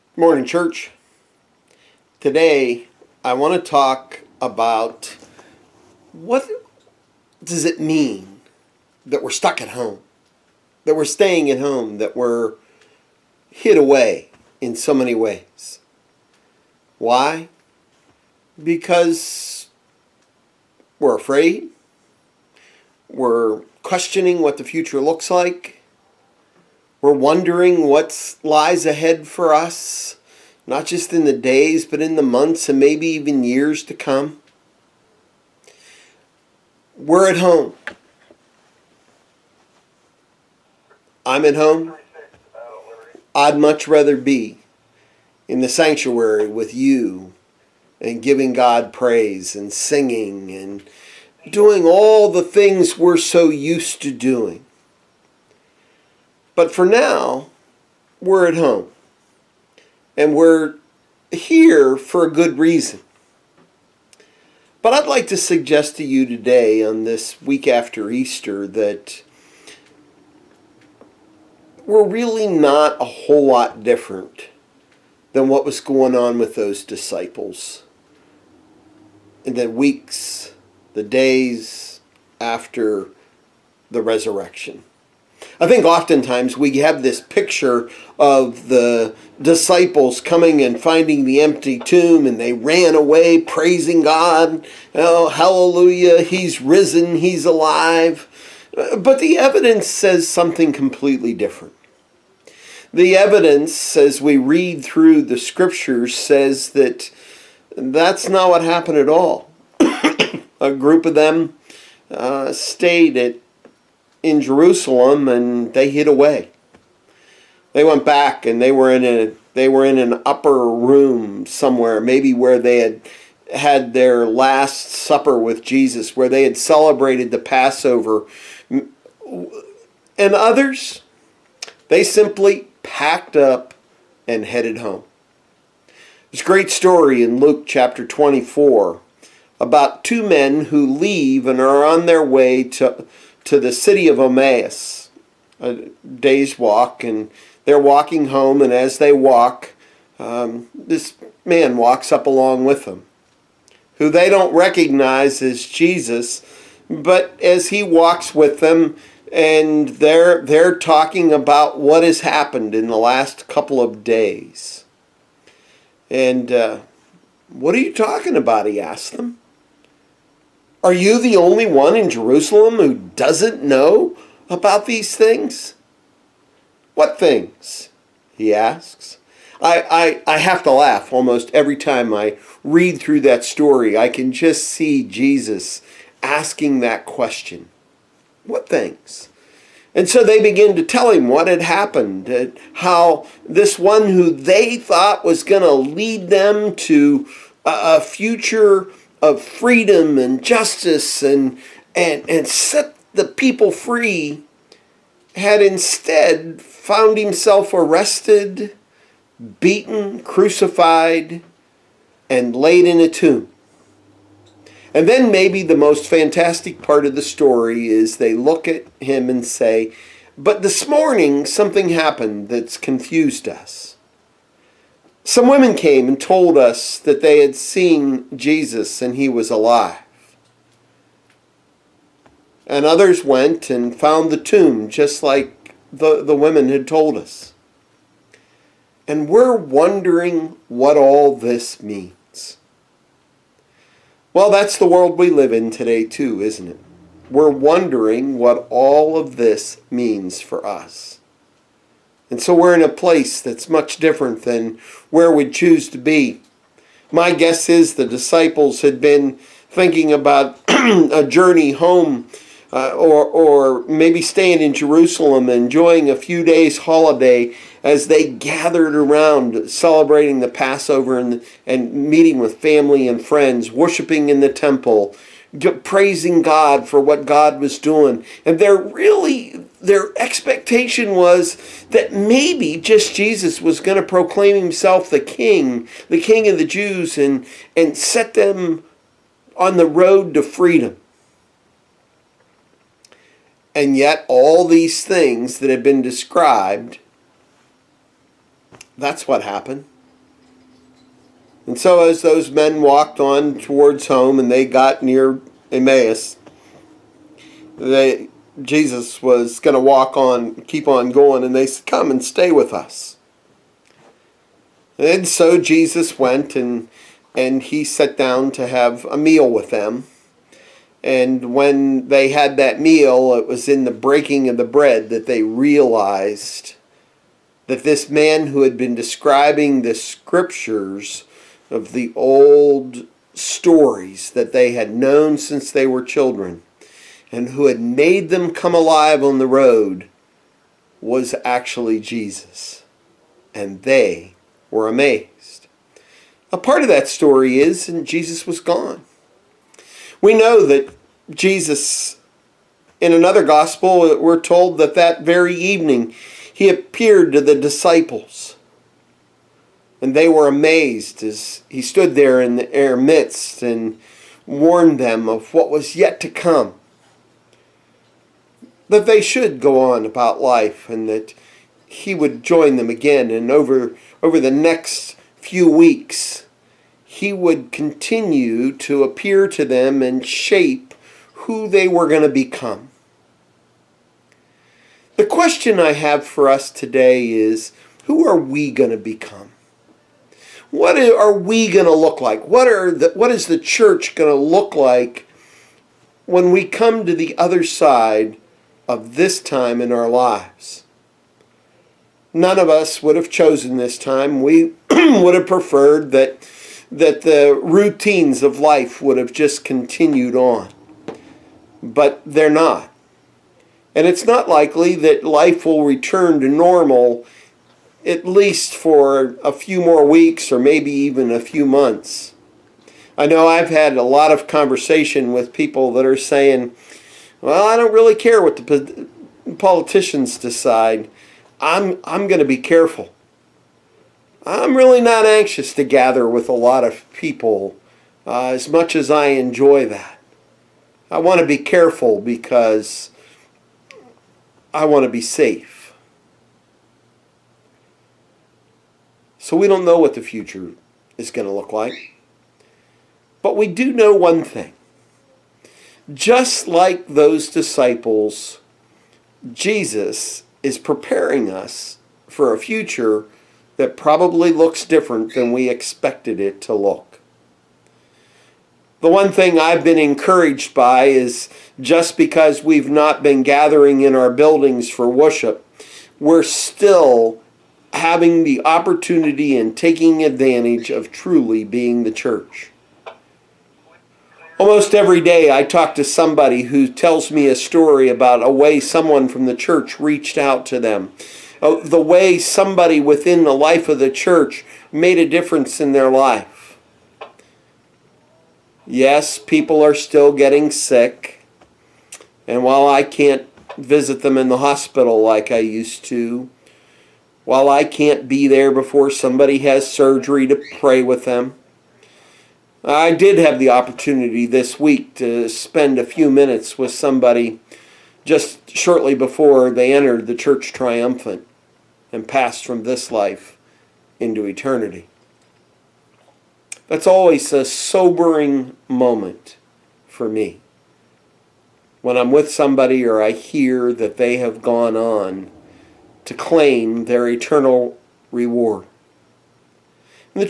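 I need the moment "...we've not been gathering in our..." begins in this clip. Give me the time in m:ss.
7:52.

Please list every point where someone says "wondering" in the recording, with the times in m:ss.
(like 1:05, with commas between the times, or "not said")
0:27, 3:59, 4:07.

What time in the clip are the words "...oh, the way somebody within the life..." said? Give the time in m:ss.
8:11.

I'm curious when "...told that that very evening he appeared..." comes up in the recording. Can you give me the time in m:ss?
5:54.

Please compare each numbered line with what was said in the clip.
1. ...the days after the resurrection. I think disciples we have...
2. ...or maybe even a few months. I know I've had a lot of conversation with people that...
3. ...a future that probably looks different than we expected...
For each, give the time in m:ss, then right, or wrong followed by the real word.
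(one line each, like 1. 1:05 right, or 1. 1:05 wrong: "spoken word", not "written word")
1. 1:20 wrong: "oftentimes", not "disciples"
2. 7:00 right
3. 7:42 right.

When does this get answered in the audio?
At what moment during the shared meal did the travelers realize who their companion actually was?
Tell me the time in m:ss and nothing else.
5:23.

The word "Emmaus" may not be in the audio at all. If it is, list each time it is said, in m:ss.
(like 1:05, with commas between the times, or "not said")
2:24, 5:05.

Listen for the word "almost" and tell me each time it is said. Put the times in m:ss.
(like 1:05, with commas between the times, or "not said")
3:01, 8:04.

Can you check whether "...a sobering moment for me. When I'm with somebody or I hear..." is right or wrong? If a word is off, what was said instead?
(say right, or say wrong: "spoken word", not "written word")
right.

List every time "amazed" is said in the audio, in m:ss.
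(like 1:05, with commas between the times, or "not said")
5:44, 6:00.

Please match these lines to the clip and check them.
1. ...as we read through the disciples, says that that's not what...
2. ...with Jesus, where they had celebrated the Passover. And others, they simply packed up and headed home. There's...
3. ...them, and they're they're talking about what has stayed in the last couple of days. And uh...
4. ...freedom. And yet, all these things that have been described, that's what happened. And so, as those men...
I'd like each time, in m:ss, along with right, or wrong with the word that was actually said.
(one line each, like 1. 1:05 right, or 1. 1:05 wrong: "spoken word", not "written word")
1. 1:43 wrong: "scriptures", not "disciples"
2. 2:05 right
3. 2:38 wrong: "happened", not "stayed"
4. 4:50 right.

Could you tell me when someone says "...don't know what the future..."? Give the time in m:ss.
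7:29.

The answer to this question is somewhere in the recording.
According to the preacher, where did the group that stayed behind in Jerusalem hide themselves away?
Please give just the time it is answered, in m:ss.
2:00.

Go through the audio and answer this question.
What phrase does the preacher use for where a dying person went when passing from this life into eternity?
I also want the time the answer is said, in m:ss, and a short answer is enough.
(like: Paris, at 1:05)
The church triumphant, at 8:40.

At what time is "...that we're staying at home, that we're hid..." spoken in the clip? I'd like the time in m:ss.
0:10.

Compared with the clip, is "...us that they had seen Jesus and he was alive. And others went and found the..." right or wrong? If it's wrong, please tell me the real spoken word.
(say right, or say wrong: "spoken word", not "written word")
right.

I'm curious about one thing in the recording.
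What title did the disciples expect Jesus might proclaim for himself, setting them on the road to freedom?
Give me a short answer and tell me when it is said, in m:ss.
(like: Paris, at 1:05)
King of the Jews, at 4:46.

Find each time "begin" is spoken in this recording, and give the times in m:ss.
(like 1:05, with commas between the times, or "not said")
3:10.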